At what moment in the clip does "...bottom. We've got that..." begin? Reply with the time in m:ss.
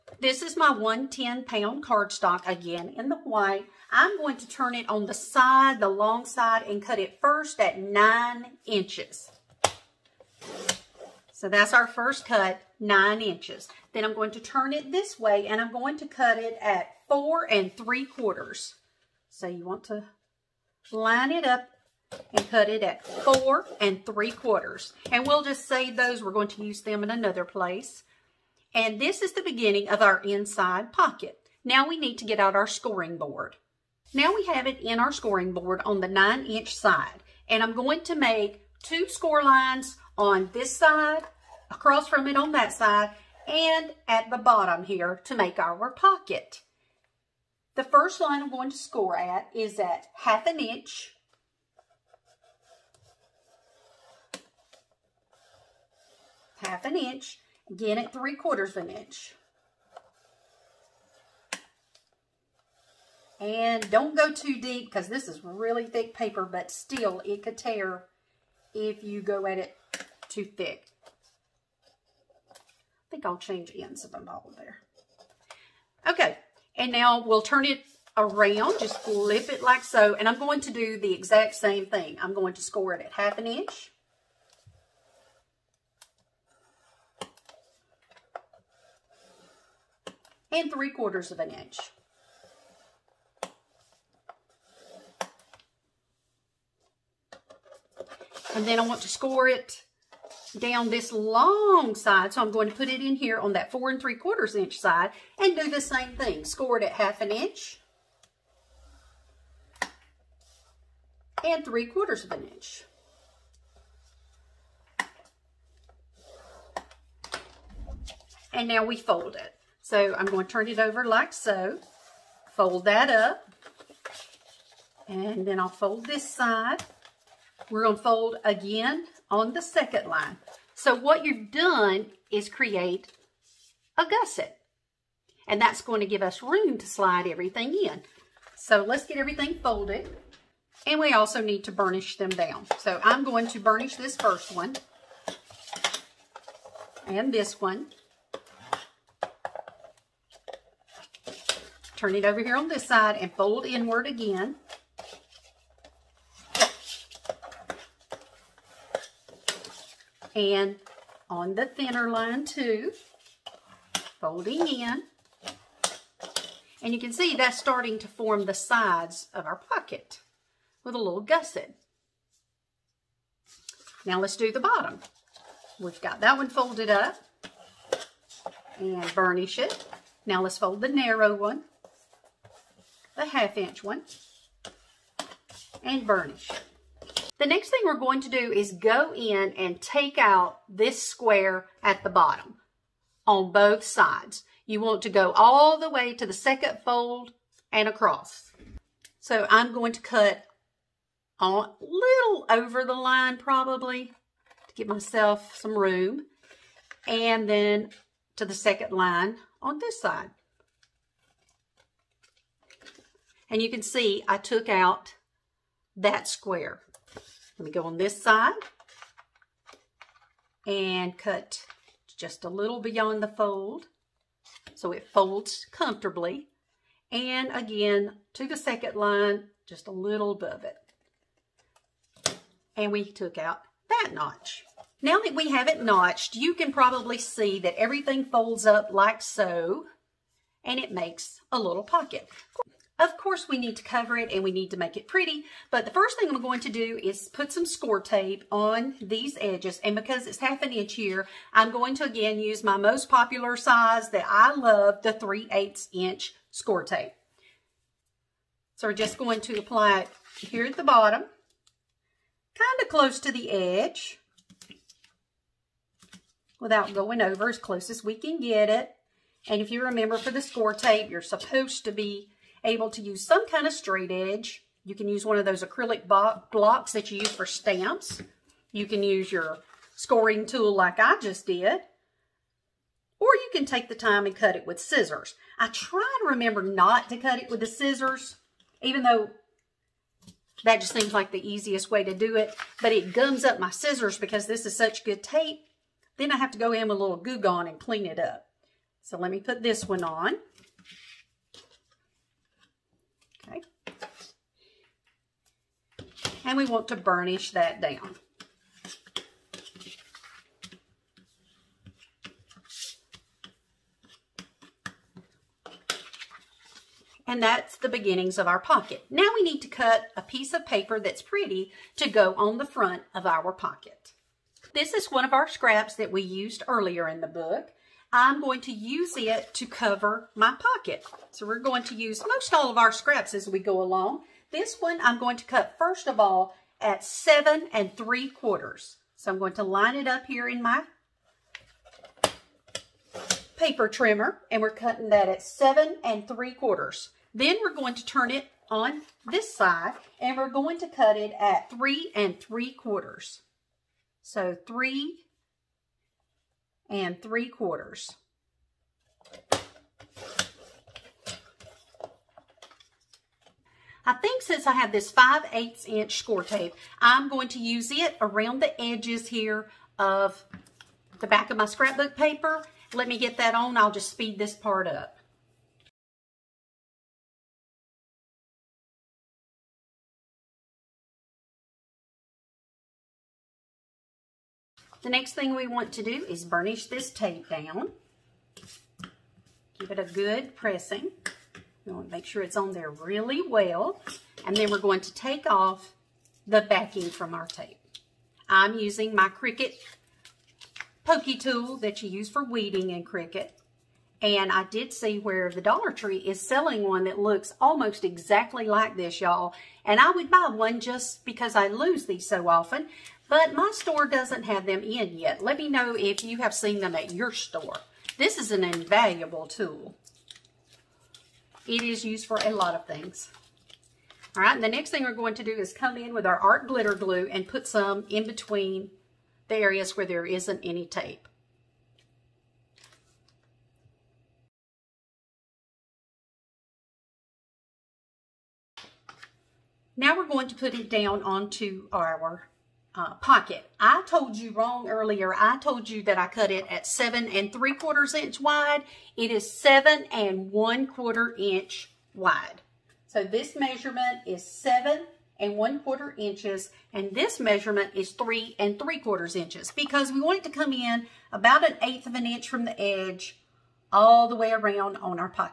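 2:54.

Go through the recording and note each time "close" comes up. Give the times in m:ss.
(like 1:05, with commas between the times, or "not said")
4:22, 4:27.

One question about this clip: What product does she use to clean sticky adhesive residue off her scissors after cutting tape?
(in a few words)
Goo Gone.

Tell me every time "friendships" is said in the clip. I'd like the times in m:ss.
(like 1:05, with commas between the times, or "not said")
not said.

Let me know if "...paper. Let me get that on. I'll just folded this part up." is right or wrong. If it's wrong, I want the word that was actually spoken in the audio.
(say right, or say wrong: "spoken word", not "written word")
wrong: "speed", not "folded".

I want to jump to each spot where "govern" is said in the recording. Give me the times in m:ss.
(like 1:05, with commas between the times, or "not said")
not said.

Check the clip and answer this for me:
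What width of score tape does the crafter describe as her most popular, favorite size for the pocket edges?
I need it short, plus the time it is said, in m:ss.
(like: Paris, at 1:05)
3/8 inch, at 4:15.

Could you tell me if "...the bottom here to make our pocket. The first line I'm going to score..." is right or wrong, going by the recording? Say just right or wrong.
right.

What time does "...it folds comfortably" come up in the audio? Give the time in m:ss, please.
3:44.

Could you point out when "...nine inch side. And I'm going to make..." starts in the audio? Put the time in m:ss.
0:36.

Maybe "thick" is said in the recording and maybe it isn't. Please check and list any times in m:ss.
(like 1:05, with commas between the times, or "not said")
1:05, 1:10.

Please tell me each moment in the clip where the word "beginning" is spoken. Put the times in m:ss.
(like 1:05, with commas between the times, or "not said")
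0:29, 5:17.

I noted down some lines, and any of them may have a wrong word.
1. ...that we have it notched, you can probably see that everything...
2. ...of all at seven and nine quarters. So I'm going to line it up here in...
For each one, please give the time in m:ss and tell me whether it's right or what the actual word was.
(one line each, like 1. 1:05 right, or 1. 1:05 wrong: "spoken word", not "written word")
1. 3:55 right
2. 5:36 wrong: "three", not "nine".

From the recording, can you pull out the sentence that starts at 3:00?
Now let's fold the narrow one, the half inch one, and burnish.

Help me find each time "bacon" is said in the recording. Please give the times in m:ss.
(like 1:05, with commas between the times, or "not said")
not said.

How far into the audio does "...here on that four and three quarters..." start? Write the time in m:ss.
1:43.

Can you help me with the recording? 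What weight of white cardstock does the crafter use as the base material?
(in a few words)
110 pound.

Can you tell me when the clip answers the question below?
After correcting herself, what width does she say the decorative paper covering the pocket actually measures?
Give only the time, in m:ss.
7:34.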